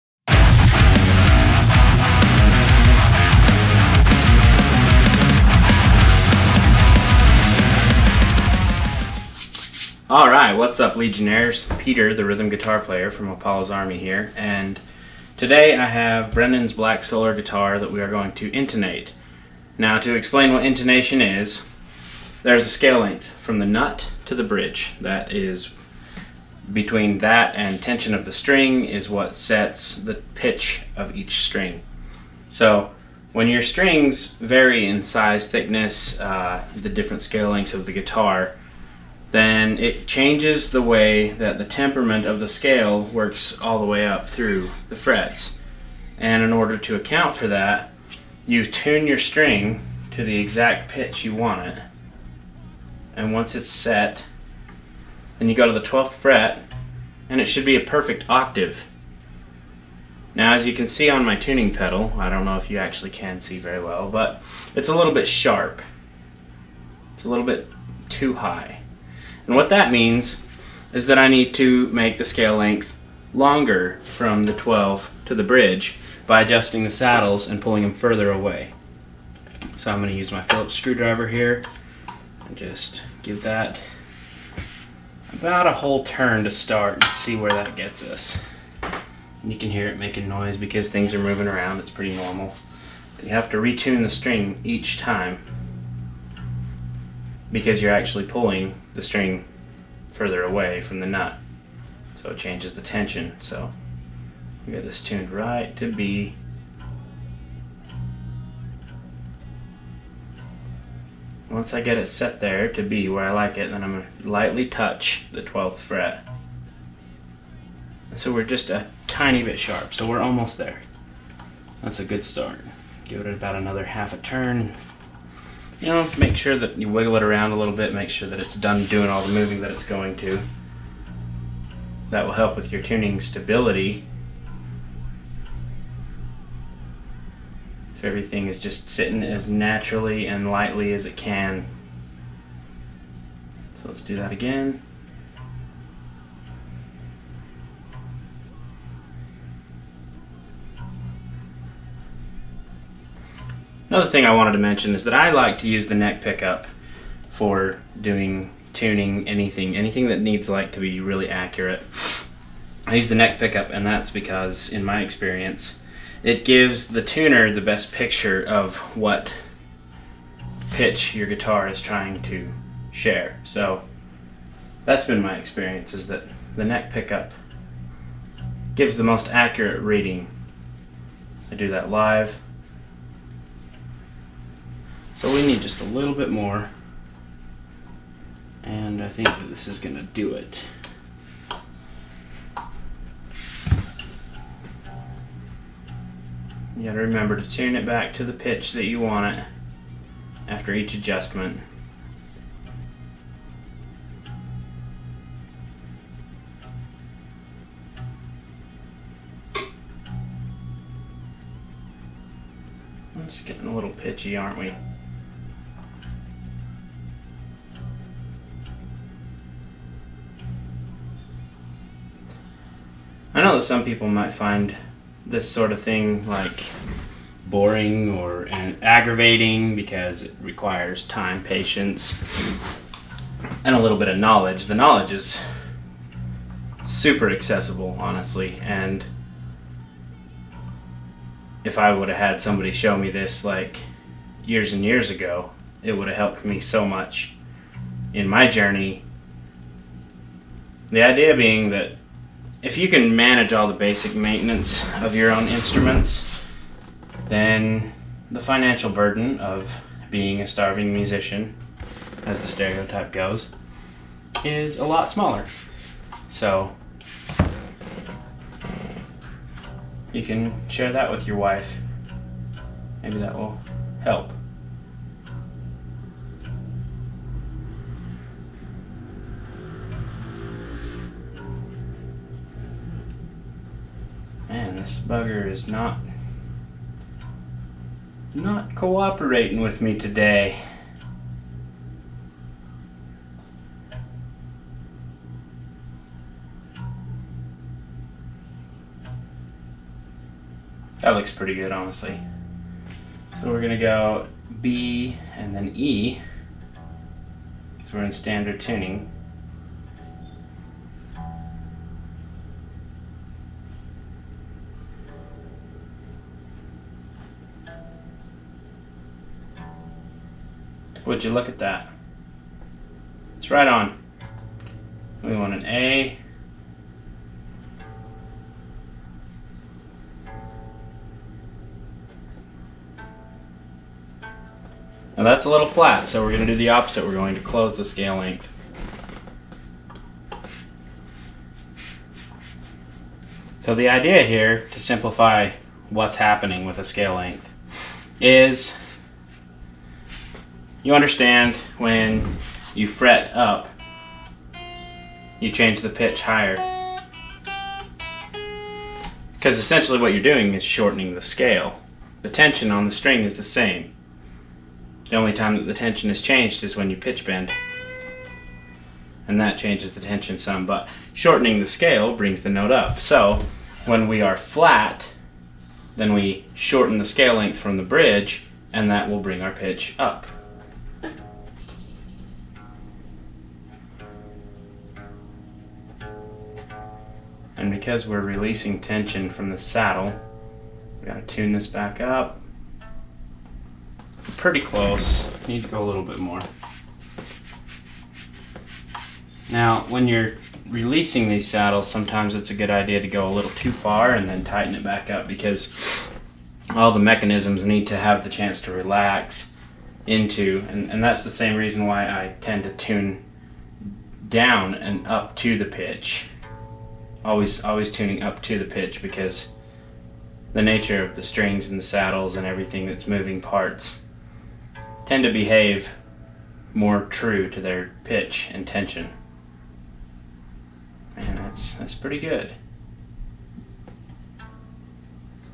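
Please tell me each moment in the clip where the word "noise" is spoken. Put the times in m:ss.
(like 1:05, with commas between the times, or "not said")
1:30.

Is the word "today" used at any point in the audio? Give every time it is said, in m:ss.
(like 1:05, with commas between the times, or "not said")
0:15, 4:49.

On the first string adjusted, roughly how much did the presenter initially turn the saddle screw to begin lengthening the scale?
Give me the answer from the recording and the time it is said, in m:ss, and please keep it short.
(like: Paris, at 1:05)
a whole turn, at 1:25.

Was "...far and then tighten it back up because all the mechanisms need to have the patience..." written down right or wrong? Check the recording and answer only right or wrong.
wrong.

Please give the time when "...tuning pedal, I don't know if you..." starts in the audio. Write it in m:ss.
1:01.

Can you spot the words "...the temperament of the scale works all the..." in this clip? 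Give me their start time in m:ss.
0:41.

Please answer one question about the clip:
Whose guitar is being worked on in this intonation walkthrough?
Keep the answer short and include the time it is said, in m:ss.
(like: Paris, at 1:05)
Brennon, at 0:16.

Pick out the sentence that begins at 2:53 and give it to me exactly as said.
So that's been my experience is that the neck pickup gives the most accurate reading.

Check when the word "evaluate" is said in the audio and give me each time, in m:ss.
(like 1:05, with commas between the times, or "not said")
not said.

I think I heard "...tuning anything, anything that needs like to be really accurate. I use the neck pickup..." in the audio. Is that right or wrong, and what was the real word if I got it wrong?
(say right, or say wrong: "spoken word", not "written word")
right.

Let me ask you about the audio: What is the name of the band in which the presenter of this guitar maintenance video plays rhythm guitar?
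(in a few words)
Apollo's Army.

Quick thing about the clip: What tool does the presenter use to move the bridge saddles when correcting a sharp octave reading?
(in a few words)
Phillips screwdriver.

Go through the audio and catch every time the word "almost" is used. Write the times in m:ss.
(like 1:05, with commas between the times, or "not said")
2:00.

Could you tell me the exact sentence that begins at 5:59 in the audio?
Because essentially what you're doing is shortening the scale.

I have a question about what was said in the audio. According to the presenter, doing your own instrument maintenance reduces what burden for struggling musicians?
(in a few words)
financial burden.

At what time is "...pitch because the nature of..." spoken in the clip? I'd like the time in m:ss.
6:58.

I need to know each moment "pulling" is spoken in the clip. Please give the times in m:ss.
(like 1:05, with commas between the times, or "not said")
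1:17, 1:38.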